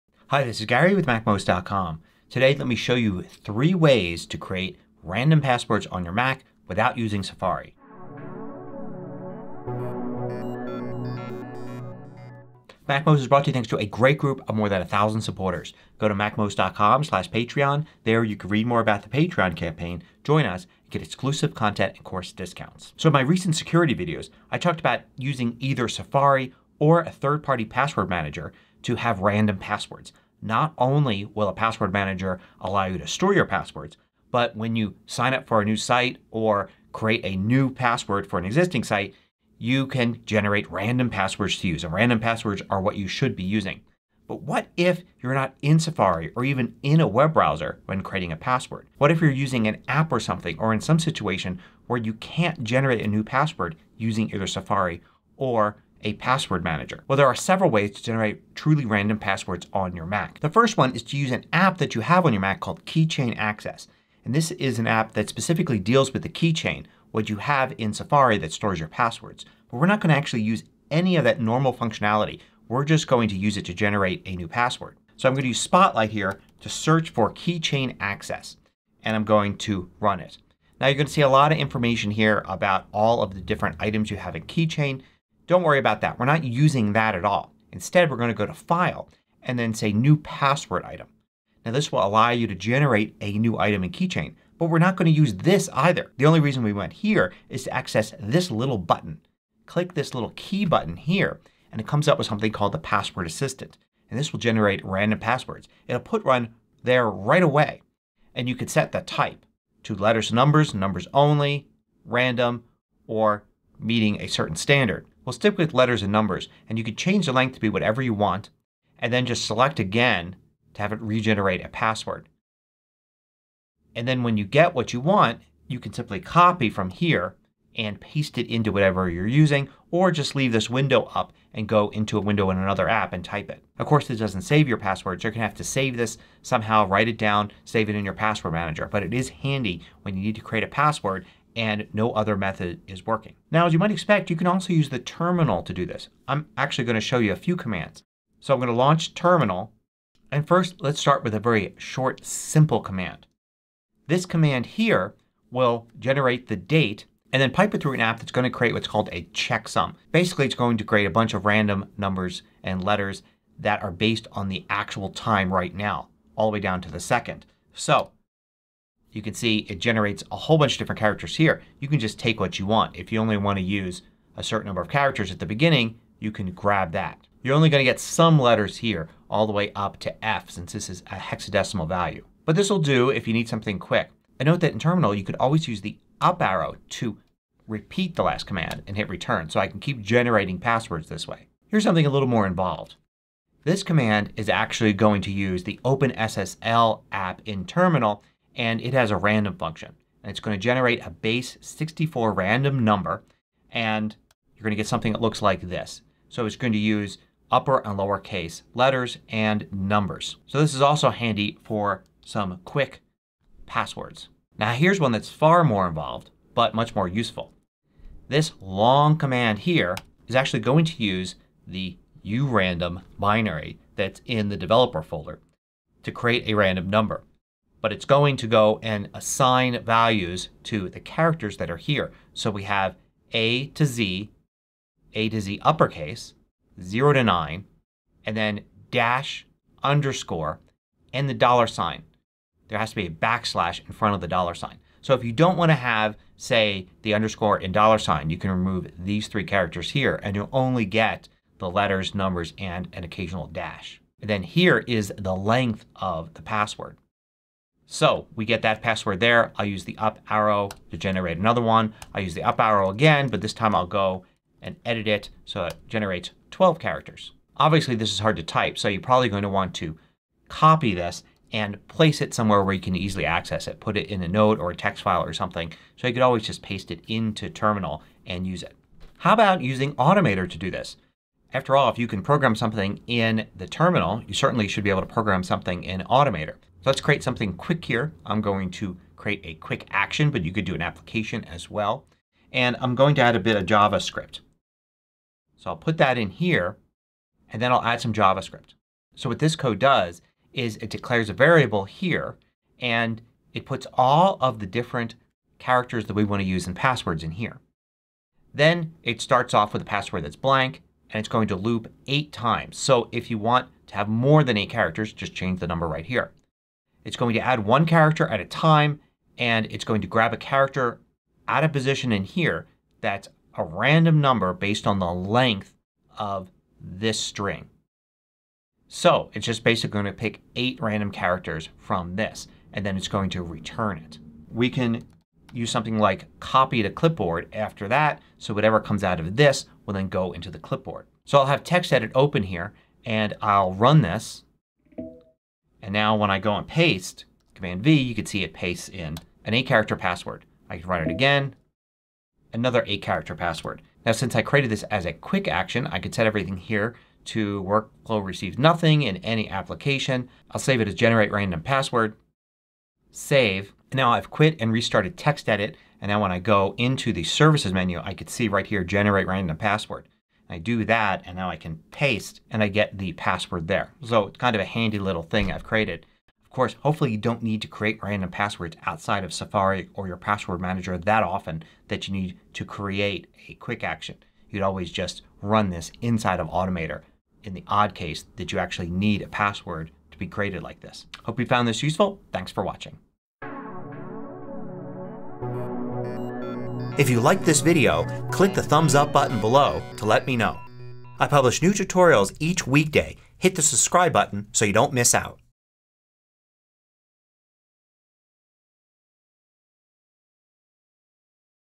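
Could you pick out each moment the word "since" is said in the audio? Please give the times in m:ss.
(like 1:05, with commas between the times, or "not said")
3:00, 5:54.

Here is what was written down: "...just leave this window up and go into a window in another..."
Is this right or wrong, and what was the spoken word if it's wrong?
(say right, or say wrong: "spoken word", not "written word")
right.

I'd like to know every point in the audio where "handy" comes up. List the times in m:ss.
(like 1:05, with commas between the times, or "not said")
2:19, 3:31, 6:14.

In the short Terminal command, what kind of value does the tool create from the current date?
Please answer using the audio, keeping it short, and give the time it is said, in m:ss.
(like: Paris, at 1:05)
checksum, at 2:39.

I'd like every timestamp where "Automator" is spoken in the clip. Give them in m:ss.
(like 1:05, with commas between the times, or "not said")
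4:39, 4:46, 6:26.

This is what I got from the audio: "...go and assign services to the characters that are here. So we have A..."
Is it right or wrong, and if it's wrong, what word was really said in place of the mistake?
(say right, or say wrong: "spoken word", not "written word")
wrong: "values", not "services".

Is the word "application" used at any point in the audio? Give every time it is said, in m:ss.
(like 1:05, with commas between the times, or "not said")
4:50, 5:59.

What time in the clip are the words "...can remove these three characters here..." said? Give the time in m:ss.
4:08.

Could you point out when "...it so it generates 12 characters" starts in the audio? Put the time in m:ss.
4:25.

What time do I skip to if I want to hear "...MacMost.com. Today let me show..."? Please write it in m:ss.
0:01.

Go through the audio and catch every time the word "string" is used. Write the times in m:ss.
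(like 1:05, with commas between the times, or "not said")
5:27.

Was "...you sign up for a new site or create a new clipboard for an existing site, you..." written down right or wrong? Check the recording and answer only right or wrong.
wrong.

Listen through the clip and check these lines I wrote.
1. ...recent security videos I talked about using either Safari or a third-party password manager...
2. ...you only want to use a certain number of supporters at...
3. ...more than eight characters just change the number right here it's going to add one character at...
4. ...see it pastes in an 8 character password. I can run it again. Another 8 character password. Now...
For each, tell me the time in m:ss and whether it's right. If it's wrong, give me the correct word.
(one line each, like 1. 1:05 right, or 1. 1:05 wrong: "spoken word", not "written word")
1. 0:23 right
2. 2:53 wrong: "characters", not "supporters"
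3. 5:14 right
4. 5:48 right.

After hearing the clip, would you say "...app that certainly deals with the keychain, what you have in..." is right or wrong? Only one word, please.
wrong.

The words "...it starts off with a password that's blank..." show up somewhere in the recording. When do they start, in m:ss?
5:09.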